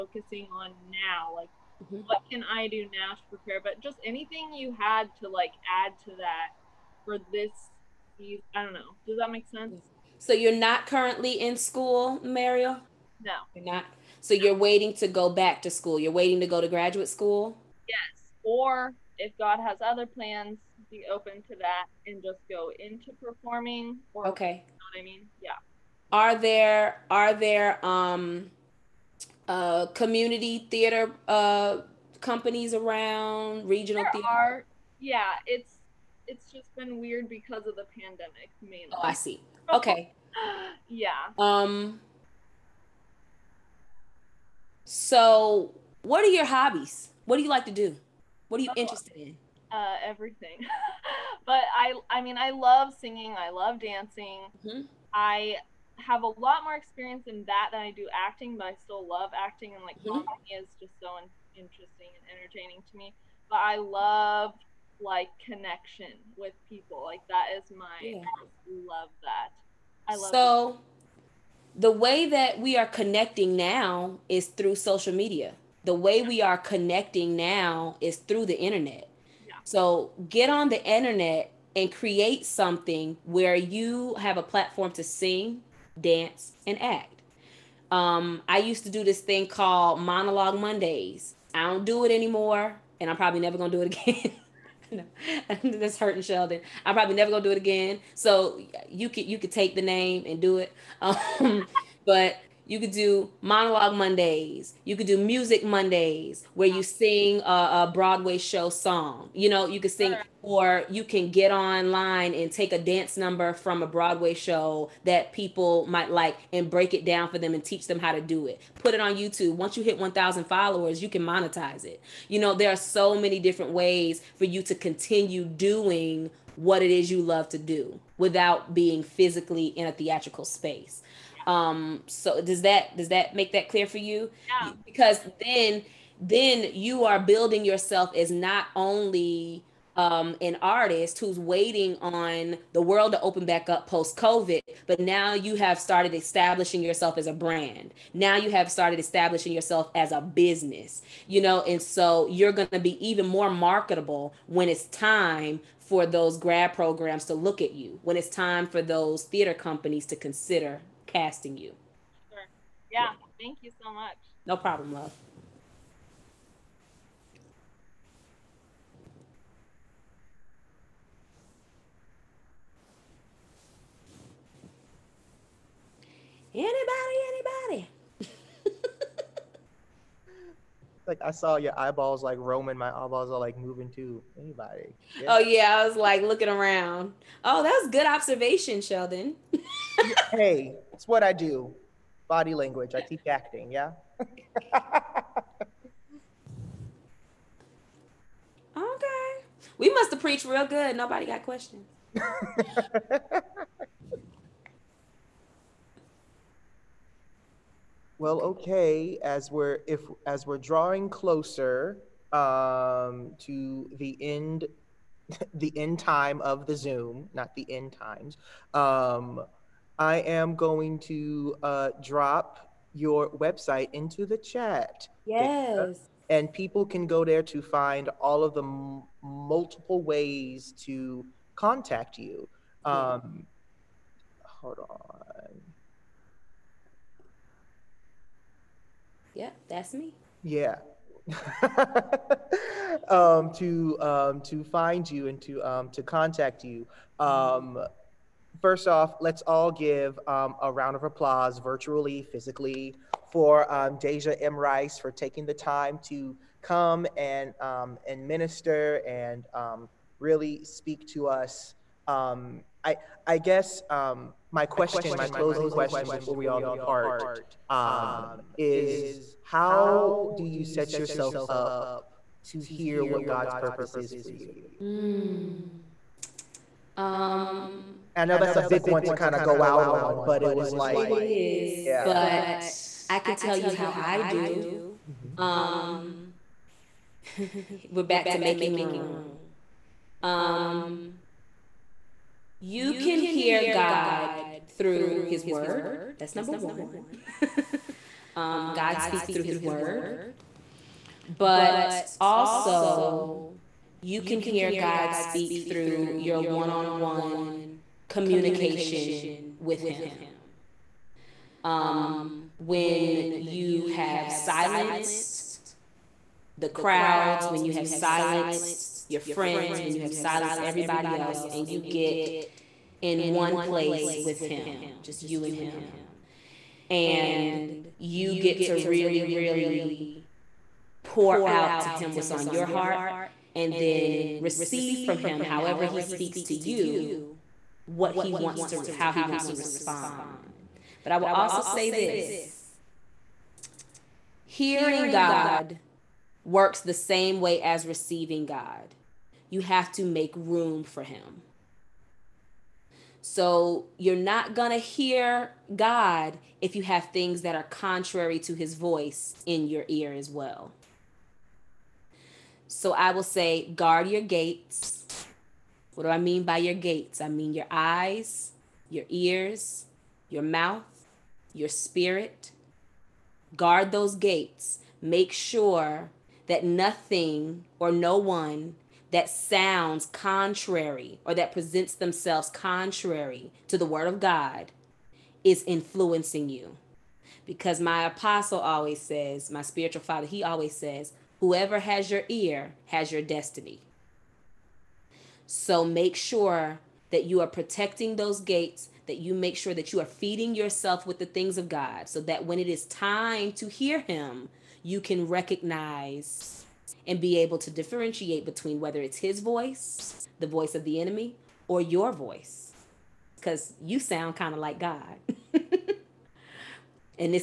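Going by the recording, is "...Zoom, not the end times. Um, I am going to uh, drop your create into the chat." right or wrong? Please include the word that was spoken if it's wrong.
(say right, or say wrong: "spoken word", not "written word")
wrong: "website", not "create".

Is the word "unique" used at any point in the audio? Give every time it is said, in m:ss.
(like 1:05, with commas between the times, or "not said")
not said.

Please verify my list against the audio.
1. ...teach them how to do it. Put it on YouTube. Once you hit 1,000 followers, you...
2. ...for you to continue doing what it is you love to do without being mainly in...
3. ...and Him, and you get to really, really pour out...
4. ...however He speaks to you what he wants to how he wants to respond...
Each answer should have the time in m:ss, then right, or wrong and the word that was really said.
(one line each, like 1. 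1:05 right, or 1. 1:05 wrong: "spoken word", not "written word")
1. 1:57 right
2. 2:04 wrong: "physically", not "mainly"
3. 5:25 right
4. 5:35 right.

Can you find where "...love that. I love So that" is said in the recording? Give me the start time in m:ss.
1:08.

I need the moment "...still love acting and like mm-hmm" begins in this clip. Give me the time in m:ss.
0:58.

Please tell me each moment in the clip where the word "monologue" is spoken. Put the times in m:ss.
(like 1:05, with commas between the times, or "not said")
1:30, 1:43.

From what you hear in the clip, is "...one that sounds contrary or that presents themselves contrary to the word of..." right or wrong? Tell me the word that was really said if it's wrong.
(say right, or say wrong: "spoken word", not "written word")
right.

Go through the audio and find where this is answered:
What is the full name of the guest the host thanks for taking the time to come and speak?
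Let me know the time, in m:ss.
4:14.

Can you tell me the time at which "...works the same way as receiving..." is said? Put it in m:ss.
5:46.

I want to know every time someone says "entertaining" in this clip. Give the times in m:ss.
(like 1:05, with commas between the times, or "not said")
1:02.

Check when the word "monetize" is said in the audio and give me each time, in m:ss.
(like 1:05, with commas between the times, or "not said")
2:01.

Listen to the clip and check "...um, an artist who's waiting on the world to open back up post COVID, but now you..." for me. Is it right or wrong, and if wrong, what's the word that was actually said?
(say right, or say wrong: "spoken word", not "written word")
right.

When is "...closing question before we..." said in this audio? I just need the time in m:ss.
4:25.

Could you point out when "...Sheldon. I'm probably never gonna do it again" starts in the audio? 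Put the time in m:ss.
1:36.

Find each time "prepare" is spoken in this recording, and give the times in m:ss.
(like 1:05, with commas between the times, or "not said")
0:03.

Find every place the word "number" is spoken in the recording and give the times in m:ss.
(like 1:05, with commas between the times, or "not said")
1:53, 4:56.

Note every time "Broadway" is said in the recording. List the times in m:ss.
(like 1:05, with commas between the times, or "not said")
1:47, 1:53.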